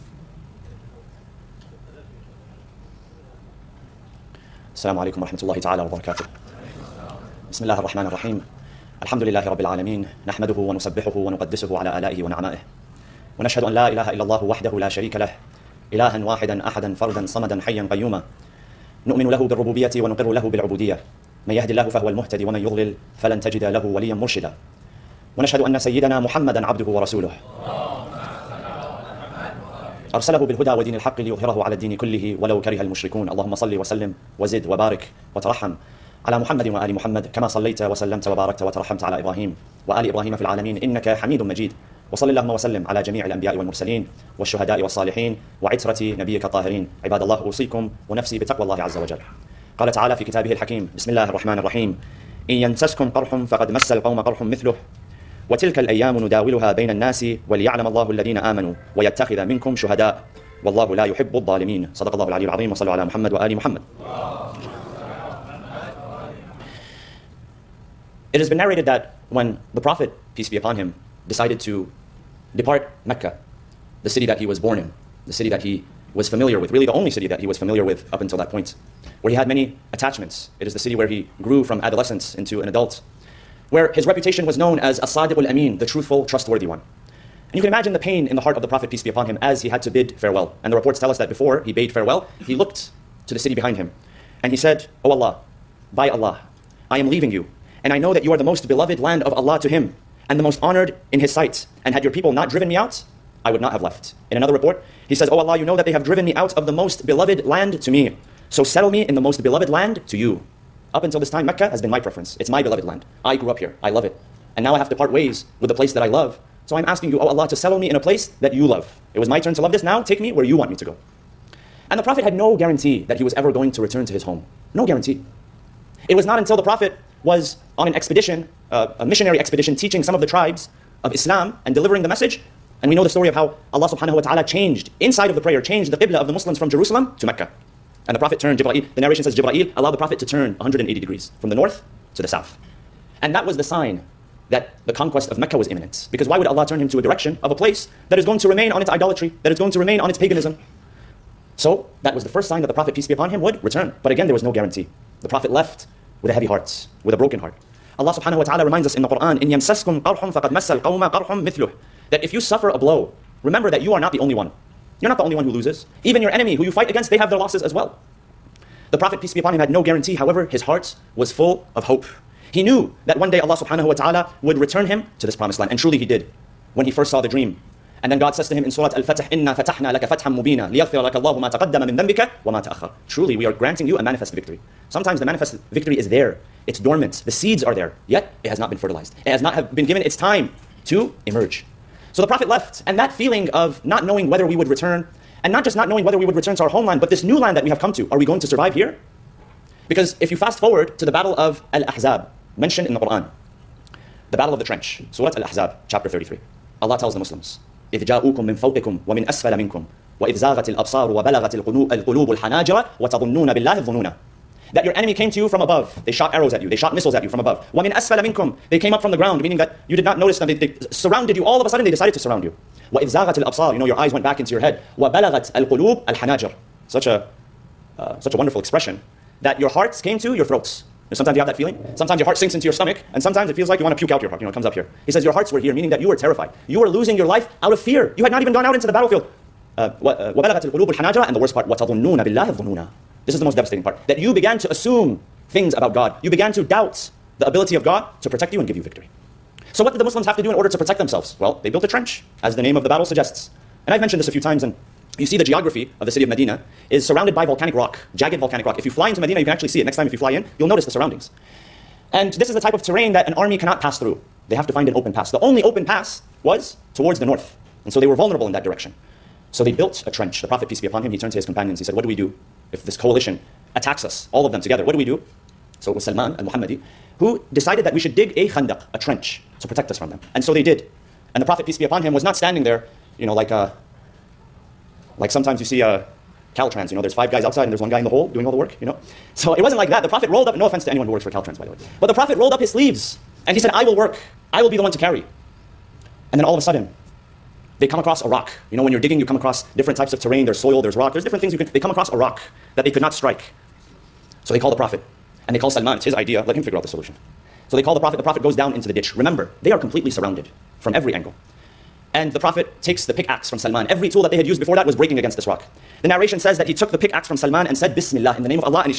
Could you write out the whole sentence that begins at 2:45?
You're not the only one who loses.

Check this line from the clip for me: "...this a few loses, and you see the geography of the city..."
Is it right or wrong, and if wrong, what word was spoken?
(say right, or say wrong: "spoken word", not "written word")
wrong: "times", not "loses".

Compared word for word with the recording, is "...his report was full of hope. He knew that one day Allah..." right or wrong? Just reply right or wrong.
wrong.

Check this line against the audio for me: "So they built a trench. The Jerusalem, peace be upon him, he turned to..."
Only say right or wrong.
wrong.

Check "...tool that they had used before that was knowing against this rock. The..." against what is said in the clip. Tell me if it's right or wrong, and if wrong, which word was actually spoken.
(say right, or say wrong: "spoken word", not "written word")
wrong: "breaking", not "knowing".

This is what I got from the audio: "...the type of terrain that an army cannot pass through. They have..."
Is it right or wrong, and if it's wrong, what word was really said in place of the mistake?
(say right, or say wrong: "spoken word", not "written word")
right.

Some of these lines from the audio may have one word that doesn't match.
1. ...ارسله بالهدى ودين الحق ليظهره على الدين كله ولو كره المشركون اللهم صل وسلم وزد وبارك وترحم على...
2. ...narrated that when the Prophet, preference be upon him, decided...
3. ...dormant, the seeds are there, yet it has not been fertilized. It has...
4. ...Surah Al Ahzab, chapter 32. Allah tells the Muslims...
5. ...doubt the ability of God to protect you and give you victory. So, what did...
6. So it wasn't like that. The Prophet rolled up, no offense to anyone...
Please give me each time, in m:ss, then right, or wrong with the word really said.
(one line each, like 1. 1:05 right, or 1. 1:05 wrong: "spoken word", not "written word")
1. 0:30 right
2. 1:08 wrong: "peace", not "preference"
3. 3:06 right
4. 3:25 wrong: "33", not "32"
5. 4:06 right
6. 4:49 right.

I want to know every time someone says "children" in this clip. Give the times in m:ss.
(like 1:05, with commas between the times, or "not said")
not said.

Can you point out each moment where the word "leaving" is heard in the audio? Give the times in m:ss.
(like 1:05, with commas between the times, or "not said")
1:37.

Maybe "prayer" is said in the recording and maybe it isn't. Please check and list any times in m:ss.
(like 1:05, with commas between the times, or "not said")
2:15.